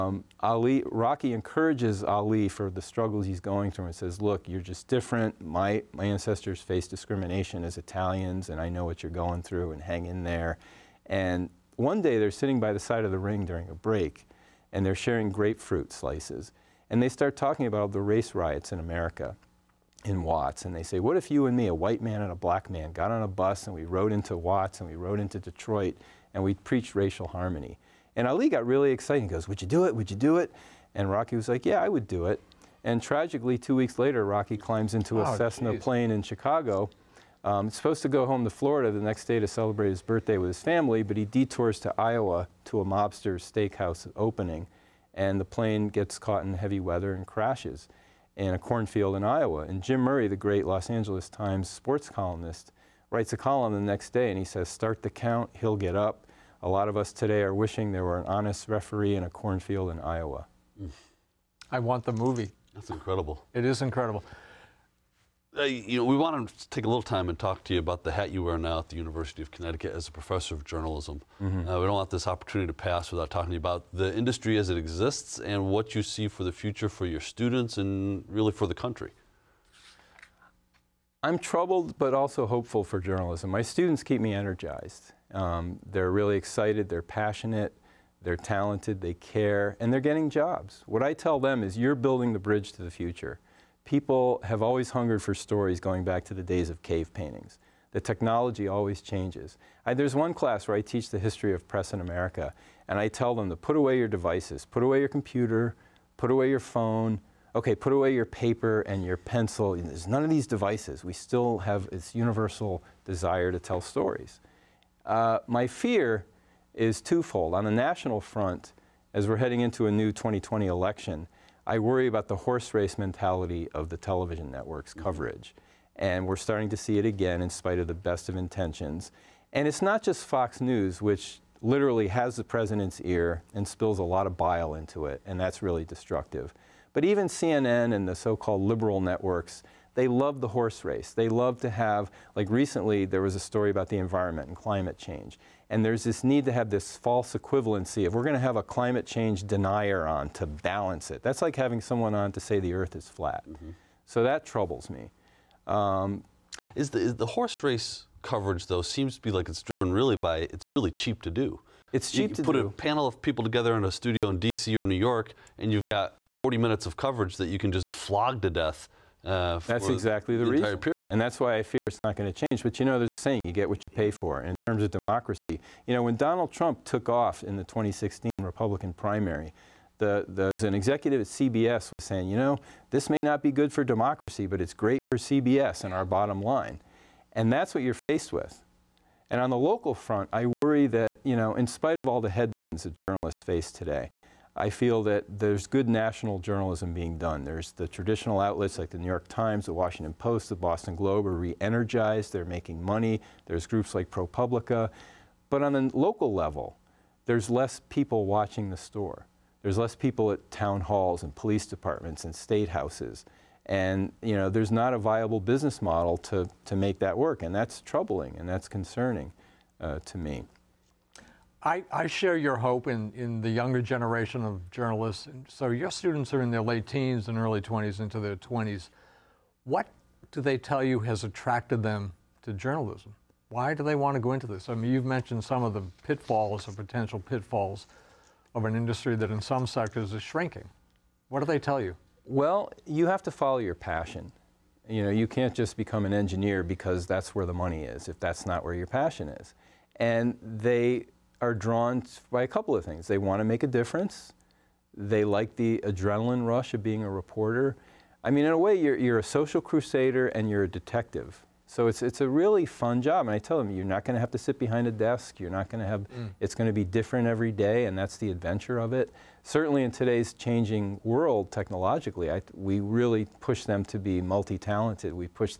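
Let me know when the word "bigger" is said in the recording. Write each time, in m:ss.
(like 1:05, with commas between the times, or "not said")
not said.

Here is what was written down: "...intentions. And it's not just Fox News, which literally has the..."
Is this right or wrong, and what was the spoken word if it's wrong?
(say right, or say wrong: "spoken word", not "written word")
right.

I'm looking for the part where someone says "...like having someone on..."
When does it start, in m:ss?
2:31.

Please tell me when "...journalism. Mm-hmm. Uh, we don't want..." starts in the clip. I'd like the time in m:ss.
1:10.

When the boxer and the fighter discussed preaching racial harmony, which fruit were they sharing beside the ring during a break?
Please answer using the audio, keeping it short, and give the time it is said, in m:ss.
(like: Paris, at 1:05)
Grapefruit, at 0:15.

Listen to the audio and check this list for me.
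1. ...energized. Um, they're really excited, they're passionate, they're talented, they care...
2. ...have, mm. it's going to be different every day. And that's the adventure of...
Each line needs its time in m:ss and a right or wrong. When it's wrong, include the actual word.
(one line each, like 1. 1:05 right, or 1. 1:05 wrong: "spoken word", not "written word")
1. 1:24 right
2. 4:25 right.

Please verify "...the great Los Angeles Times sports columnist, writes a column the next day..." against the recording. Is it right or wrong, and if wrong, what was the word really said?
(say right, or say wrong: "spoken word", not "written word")
right.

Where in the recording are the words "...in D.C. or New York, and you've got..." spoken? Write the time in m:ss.
2:44.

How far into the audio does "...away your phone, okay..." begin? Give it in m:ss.
1:46.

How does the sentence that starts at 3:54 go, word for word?
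I mean, you've mentioned some of the pitfalls or potential pitfalls of an industry that in some sectors is shrinking.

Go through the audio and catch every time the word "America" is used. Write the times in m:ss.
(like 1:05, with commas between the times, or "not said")
0:18, 1:42.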